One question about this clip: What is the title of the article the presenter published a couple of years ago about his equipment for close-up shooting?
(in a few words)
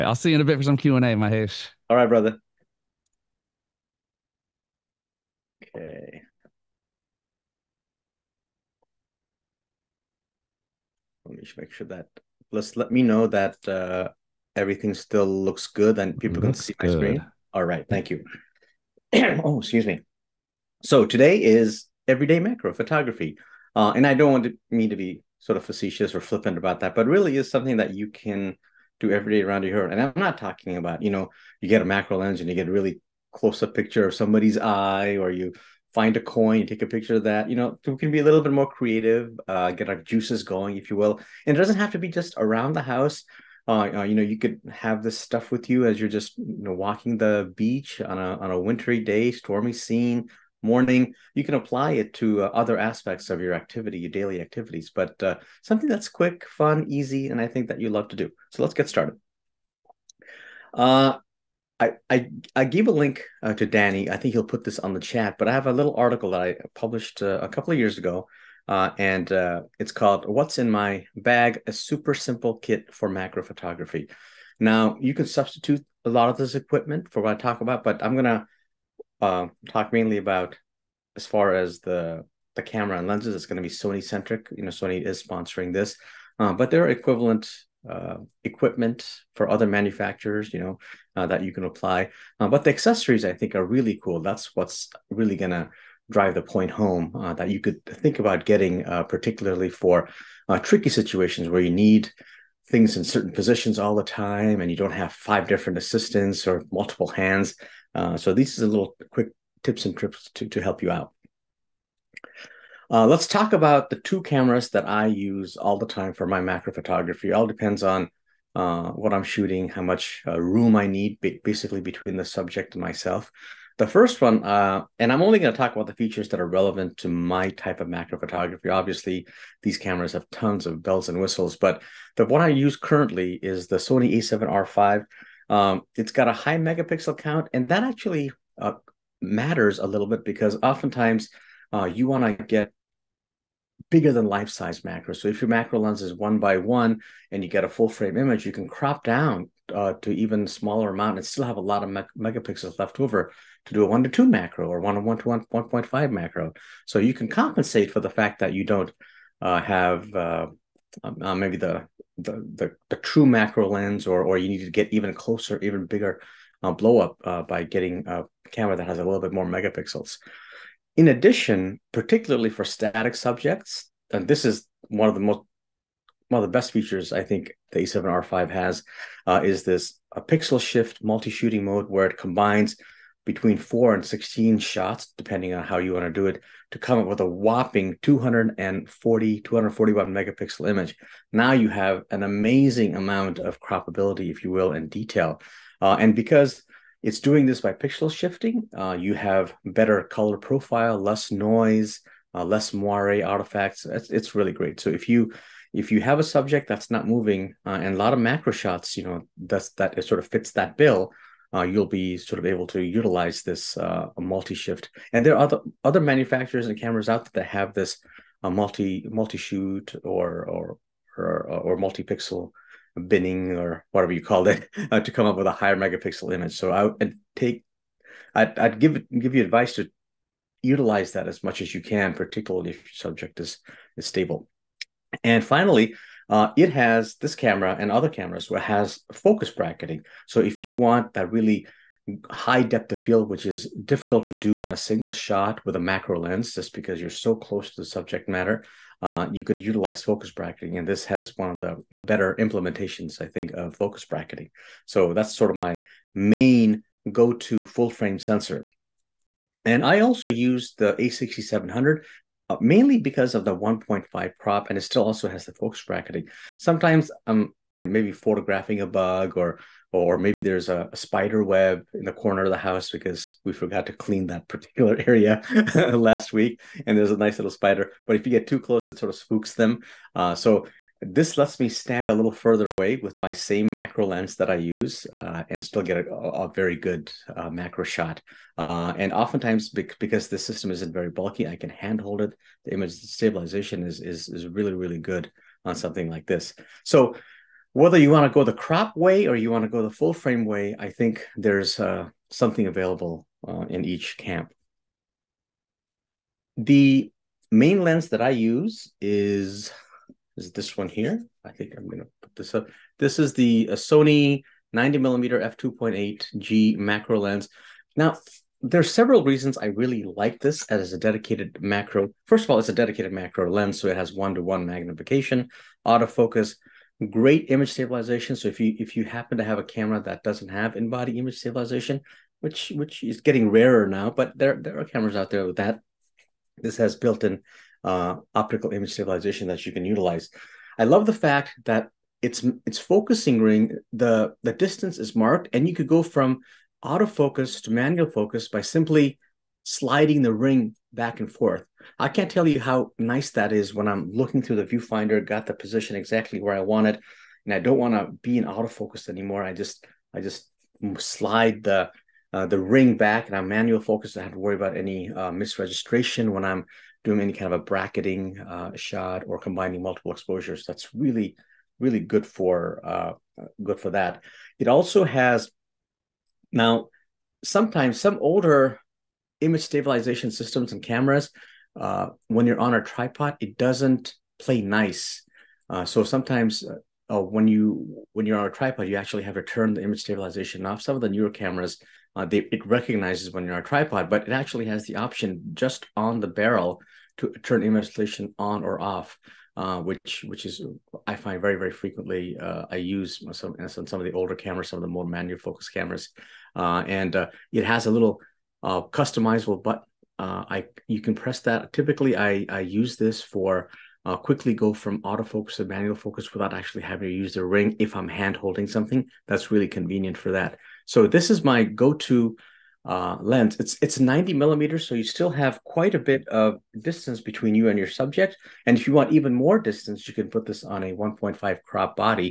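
What's in My Bag?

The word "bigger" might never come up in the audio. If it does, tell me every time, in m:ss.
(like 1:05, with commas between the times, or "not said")
2:23, 2:45.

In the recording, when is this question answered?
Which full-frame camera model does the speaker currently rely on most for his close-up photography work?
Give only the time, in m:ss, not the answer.
2:13.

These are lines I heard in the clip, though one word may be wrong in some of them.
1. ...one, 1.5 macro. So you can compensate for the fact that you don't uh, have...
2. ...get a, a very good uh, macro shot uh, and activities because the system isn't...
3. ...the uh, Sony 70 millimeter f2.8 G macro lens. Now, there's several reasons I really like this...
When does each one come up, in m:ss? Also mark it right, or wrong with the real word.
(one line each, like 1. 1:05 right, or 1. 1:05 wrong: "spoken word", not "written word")
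1. 2:35 right
2. 4:45 wrong: "oftentimes", not "activities"
3. 5:13 wrong: "90", not "70".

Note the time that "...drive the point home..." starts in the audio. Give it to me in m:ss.
1:36.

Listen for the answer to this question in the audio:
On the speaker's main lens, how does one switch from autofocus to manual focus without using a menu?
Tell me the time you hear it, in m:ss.
5:49.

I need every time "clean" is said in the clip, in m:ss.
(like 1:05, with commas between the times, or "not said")
4:33.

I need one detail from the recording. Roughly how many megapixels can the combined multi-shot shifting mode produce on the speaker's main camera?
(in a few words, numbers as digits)
241.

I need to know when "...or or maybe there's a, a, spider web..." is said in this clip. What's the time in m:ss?
4:29.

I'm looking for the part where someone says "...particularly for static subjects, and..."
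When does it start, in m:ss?
2:51.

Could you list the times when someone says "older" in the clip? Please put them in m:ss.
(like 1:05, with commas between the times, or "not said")
6:18, 6:44.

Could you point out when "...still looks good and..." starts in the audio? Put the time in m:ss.
0:14.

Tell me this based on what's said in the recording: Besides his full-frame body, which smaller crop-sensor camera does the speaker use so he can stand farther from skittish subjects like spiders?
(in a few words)
A6700.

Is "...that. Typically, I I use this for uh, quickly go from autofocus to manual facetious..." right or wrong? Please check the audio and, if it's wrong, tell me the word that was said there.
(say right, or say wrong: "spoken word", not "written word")
wrong: "focus", not "facetious".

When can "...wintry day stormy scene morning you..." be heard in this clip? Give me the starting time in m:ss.
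0:48.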